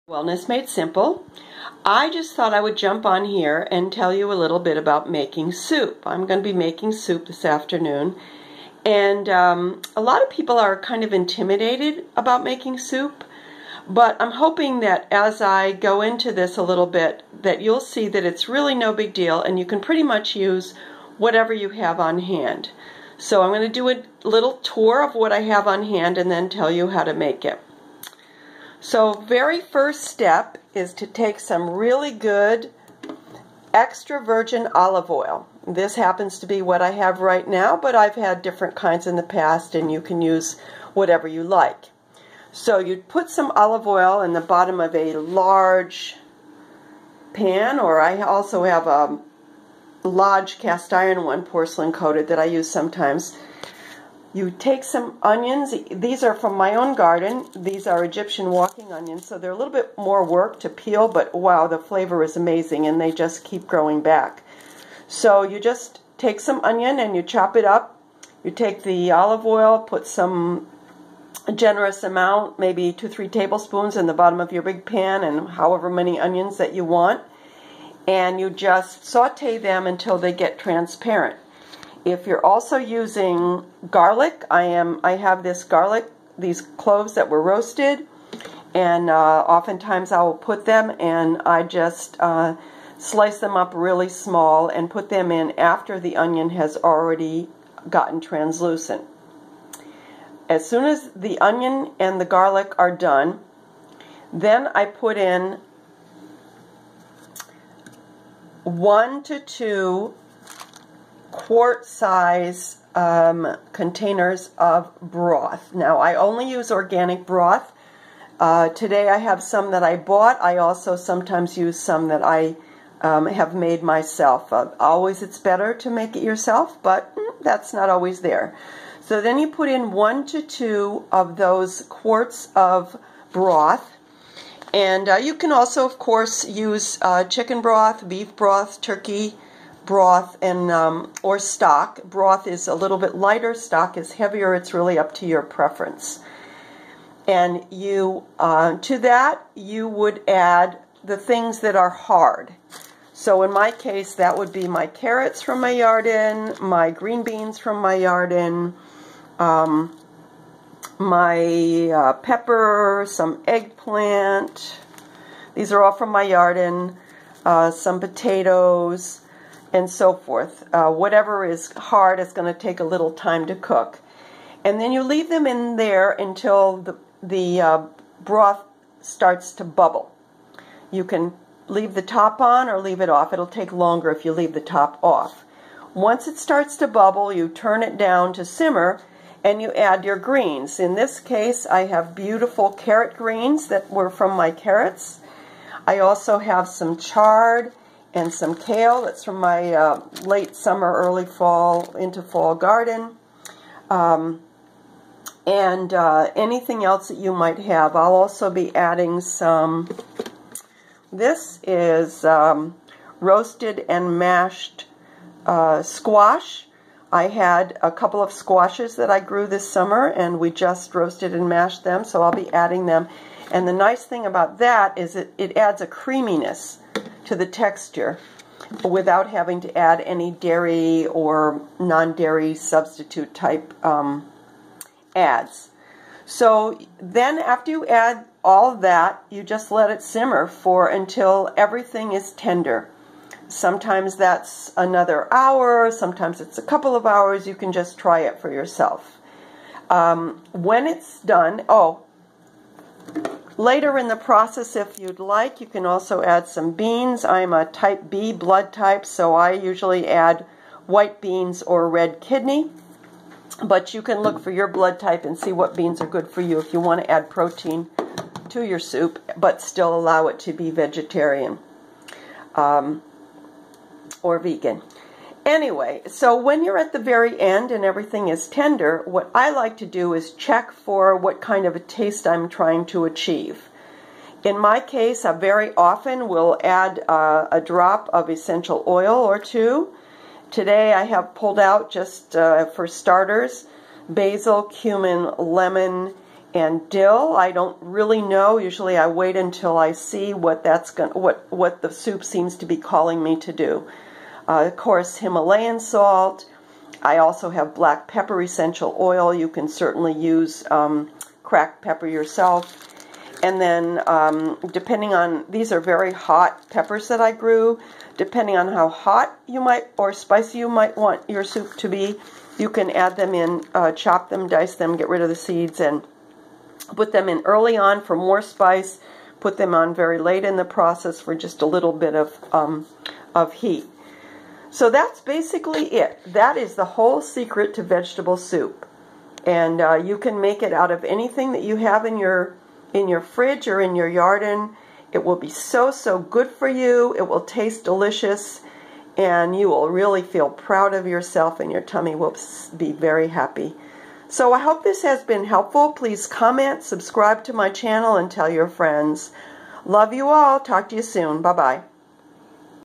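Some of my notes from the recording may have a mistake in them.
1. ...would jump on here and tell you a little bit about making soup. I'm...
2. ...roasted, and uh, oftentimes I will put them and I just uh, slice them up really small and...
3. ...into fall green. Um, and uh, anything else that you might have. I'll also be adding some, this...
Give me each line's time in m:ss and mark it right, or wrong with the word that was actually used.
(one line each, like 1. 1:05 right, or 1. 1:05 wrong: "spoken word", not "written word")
1. 0:02 right
2. 1:27 right
3. 3:21 wrong: "garden", not "green".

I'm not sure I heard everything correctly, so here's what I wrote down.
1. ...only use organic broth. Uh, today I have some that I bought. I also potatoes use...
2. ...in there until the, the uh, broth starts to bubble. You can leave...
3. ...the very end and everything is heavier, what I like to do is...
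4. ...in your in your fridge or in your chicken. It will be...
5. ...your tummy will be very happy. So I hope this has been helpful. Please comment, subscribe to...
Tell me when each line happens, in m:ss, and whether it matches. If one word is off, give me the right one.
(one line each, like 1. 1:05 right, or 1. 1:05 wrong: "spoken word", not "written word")
1. 1:56 wrong: "sometimes", not "potatoes"
2. 2:55 right
3. 4:36 wrong: "tender", not "heavier"
4. 5:42 wrong: "garden", not "chicken"
5. 5:51 right.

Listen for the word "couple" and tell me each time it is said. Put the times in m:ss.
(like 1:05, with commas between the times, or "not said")
3:37, 4:06.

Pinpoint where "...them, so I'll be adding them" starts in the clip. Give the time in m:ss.
3:41.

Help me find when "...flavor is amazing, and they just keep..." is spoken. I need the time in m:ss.
1:01.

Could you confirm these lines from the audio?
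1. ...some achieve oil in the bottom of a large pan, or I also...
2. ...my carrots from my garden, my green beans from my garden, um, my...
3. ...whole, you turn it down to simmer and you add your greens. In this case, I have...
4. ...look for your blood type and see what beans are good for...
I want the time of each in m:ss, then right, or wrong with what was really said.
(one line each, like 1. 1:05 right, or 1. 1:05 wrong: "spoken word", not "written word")
1. 0:43 wrong: "olive", not "achieve"
2. 2:34 right
3. 3:06 wrong: "bubble", not "whole"
4. 4:24 right.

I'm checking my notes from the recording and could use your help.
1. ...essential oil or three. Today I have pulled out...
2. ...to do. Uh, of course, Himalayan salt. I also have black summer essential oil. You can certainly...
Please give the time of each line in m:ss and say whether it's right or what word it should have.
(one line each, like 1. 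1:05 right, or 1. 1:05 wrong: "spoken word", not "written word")
1. 4:48 wrong: "two", not "three"
2. 5:03 wrong: "pepper", not "summer".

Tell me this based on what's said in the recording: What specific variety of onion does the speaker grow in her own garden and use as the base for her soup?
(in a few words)
Egyptian walking onions.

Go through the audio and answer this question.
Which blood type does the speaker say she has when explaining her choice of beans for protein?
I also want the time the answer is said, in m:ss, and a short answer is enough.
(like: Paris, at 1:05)
Type B, at 4:17.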